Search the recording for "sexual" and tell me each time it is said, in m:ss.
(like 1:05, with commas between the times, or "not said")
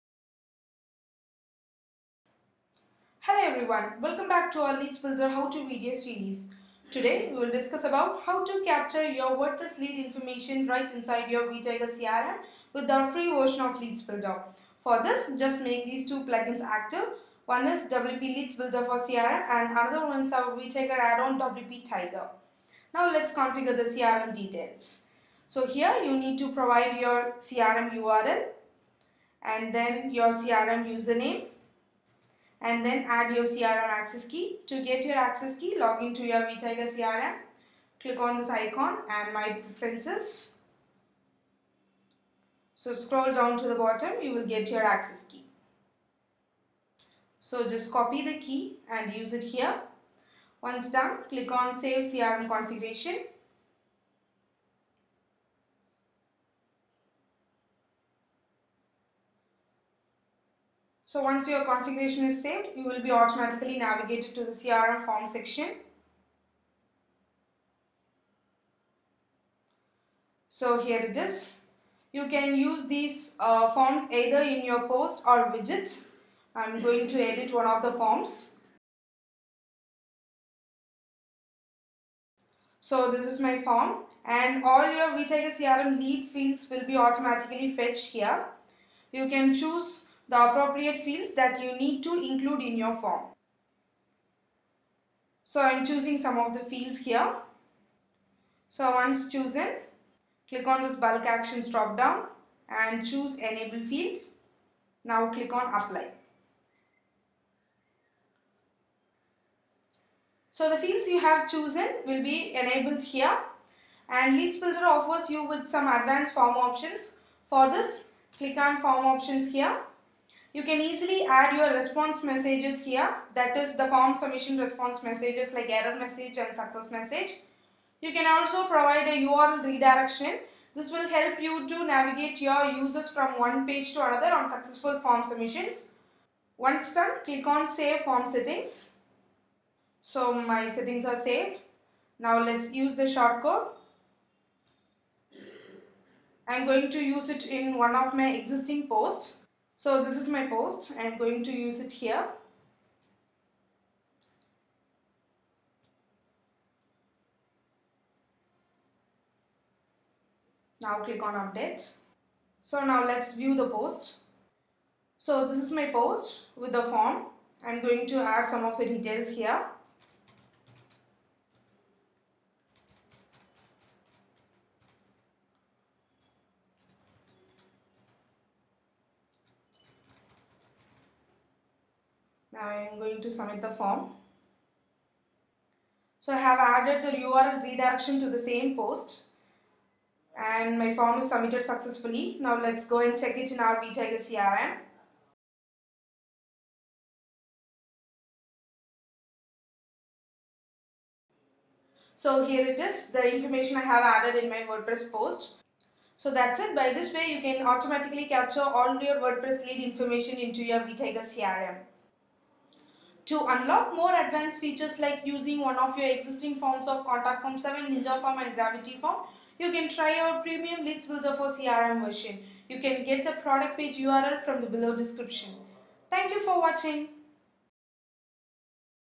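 not said.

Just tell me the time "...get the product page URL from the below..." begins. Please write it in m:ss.
3:43.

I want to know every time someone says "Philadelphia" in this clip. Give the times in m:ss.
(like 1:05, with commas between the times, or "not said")
not said.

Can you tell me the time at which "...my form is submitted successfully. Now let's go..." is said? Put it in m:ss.
3:10.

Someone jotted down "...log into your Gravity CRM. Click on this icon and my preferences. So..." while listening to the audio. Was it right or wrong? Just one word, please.
wrong.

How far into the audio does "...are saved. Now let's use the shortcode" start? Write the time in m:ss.
2:21.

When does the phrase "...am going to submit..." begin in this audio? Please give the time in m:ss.
3:02.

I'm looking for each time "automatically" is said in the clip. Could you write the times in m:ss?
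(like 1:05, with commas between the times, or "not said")
1:03, 1:26, 3:27.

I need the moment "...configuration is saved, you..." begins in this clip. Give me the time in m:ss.
1:01.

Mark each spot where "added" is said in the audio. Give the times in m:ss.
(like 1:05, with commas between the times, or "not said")
3:06, 3:24.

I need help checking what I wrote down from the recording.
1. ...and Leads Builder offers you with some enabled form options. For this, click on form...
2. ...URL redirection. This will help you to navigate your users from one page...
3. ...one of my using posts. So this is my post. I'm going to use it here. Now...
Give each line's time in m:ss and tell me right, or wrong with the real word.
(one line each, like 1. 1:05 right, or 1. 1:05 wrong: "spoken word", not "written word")
1. 1:54 wrong: "advanced", not "enabled"
2. 2:09 right
3. 2:27 wrong: "existing", not "using".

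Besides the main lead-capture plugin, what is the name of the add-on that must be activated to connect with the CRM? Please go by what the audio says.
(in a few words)
WP Tiger.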